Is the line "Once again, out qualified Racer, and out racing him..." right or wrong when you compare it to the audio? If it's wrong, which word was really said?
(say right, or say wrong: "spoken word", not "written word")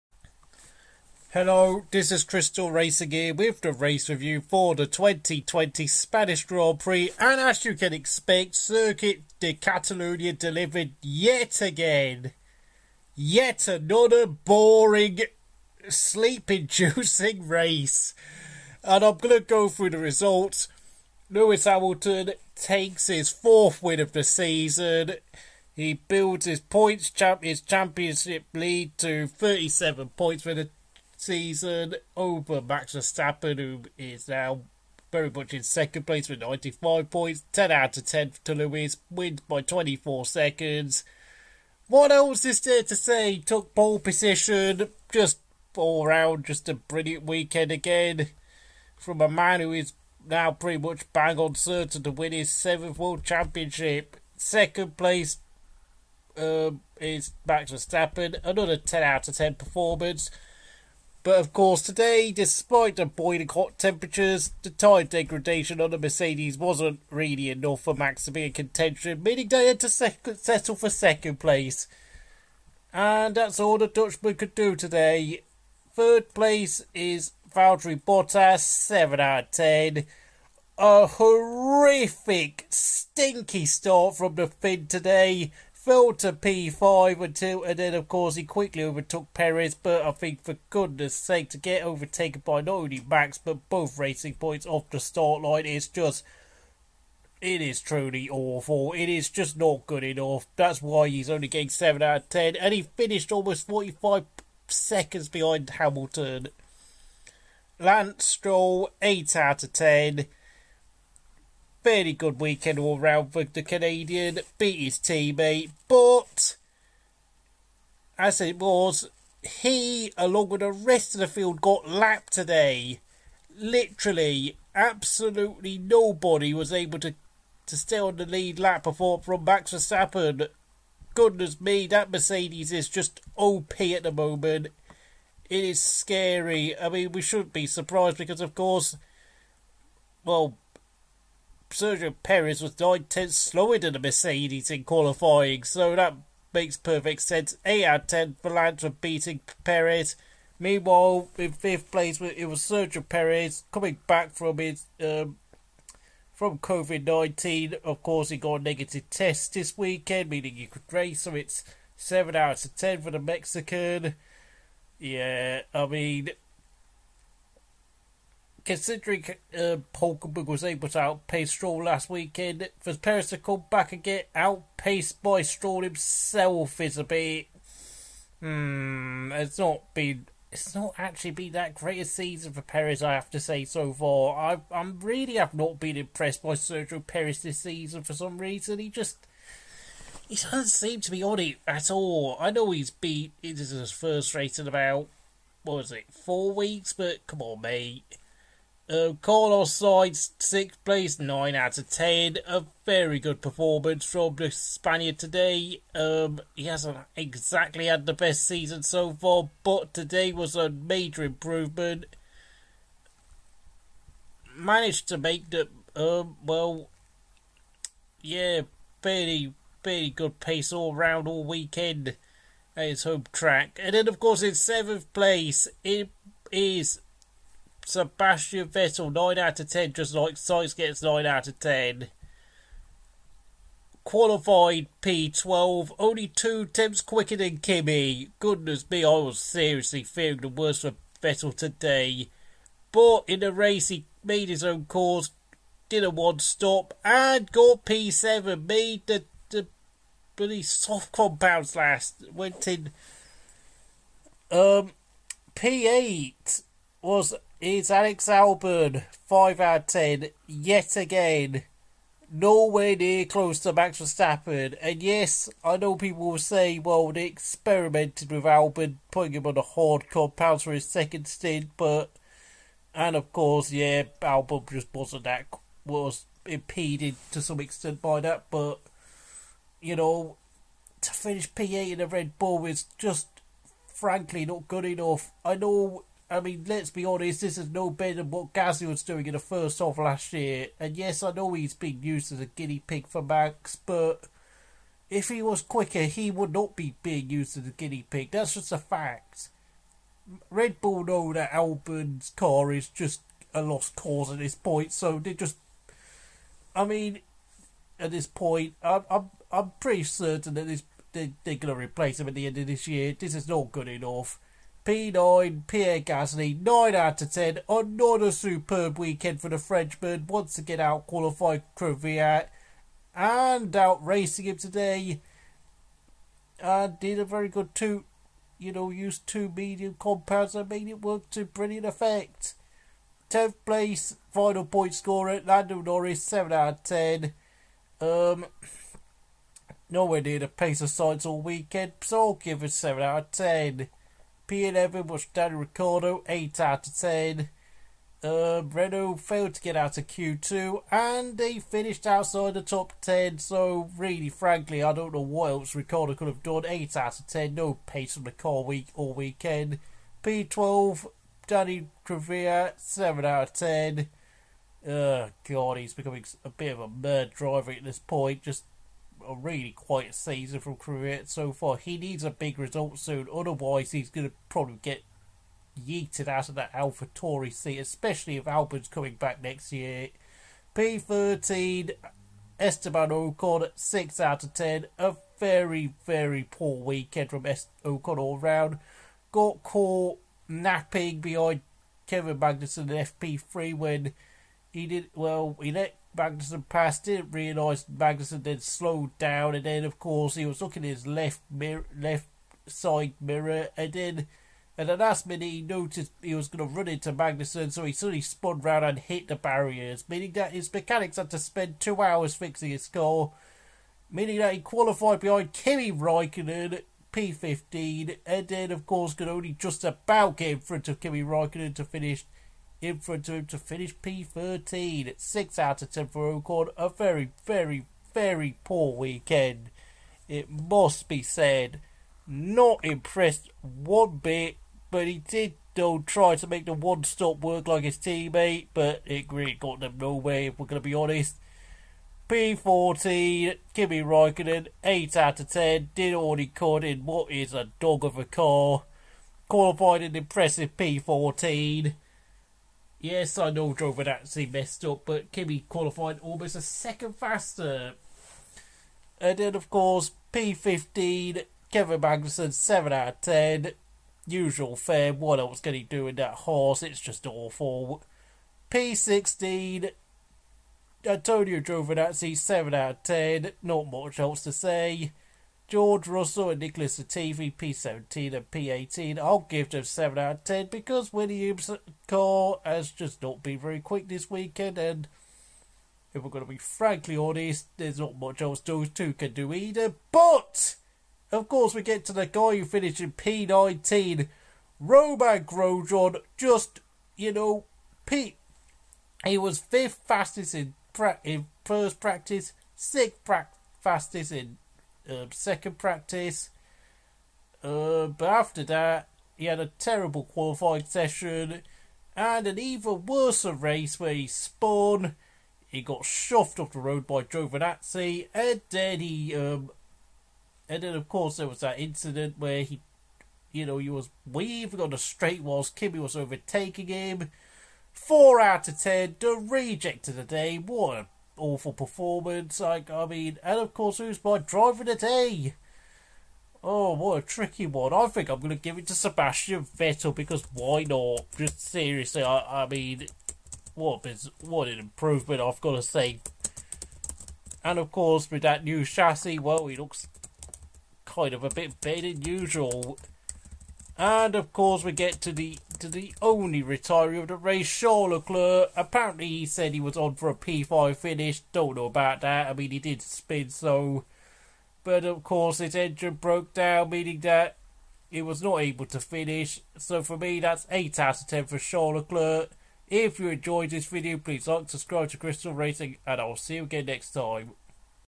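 wrong: "Kvyat", not "Racer".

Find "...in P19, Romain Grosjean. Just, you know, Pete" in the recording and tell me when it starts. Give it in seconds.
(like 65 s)
492 s.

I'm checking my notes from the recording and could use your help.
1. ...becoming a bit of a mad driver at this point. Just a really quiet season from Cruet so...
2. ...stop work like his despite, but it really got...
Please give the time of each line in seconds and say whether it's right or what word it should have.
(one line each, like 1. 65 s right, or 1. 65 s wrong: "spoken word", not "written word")
1. 365 s right
2. 437 s wrong: "teammate", not "despite".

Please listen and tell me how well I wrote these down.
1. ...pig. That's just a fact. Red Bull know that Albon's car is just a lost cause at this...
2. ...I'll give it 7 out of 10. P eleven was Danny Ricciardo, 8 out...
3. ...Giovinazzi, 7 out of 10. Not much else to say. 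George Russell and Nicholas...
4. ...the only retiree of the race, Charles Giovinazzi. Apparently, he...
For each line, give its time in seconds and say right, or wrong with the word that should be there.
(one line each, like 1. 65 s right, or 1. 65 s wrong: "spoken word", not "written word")
1. 298 s right
2. 342 s right
3. 471 s right
4. 555 s wrong: "Leclerc", not "Giovinazzi".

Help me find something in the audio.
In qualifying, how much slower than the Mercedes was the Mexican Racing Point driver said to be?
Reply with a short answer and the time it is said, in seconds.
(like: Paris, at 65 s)
nine tenths, at 142 s.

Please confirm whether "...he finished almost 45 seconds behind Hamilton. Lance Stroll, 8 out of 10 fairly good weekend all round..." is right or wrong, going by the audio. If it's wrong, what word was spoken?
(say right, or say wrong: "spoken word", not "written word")
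right.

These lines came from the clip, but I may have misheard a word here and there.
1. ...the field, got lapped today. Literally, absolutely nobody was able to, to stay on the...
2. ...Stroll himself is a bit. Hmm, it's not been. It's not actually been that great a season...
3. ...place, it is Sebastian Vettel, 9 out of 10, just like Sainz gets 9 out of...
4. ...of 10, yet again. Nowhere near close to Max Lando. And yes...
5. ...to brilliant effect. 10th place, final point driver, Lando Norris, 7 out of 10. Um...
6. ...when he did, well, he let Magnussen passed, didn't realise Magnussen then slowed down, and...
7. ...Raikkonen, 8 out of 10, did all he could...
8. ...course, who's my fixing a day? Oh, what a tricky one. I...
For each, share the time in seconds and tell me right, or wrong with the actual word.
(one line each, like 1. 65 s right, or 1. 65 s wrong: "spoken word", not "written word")
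1. 121 s right
2. 175 s right
3. 225 s right
4. 259 s wrong: "Verstappen", not "Lando"
5. 331 s wrong: "scorer", not "driver"
6. 393 s right
7. 444 s right
8. 533 s wrong: "driving", not "fixing".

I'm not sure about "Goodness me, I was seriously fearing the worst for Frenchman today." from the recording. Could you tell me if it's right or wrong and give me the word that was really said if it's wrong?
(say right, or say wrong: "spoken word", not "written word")
wrong: "Vettel", not "Frenchman".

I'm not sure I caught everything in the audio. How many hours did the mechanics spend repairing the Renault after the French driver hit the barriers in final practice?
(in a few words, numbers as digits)
2.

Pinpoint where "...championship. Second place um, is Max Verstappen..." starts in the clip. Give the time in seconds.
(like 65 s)
53 s.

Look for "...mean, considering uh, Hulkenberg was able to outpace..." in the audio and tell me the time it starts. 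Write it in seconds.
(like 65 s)
165 s.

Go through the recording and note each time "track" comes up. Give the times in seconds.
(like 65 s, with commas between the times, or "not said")
223 s.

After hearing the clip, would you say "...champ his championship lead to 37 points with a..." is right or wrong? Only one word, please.
right.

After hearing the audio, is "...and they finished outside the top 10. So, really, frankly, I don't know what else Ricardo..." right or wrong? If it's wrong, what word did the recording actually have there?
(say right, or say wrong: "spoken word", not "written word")
right.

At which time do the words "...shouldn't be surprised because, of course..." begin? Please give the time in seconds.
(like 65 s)
137 s.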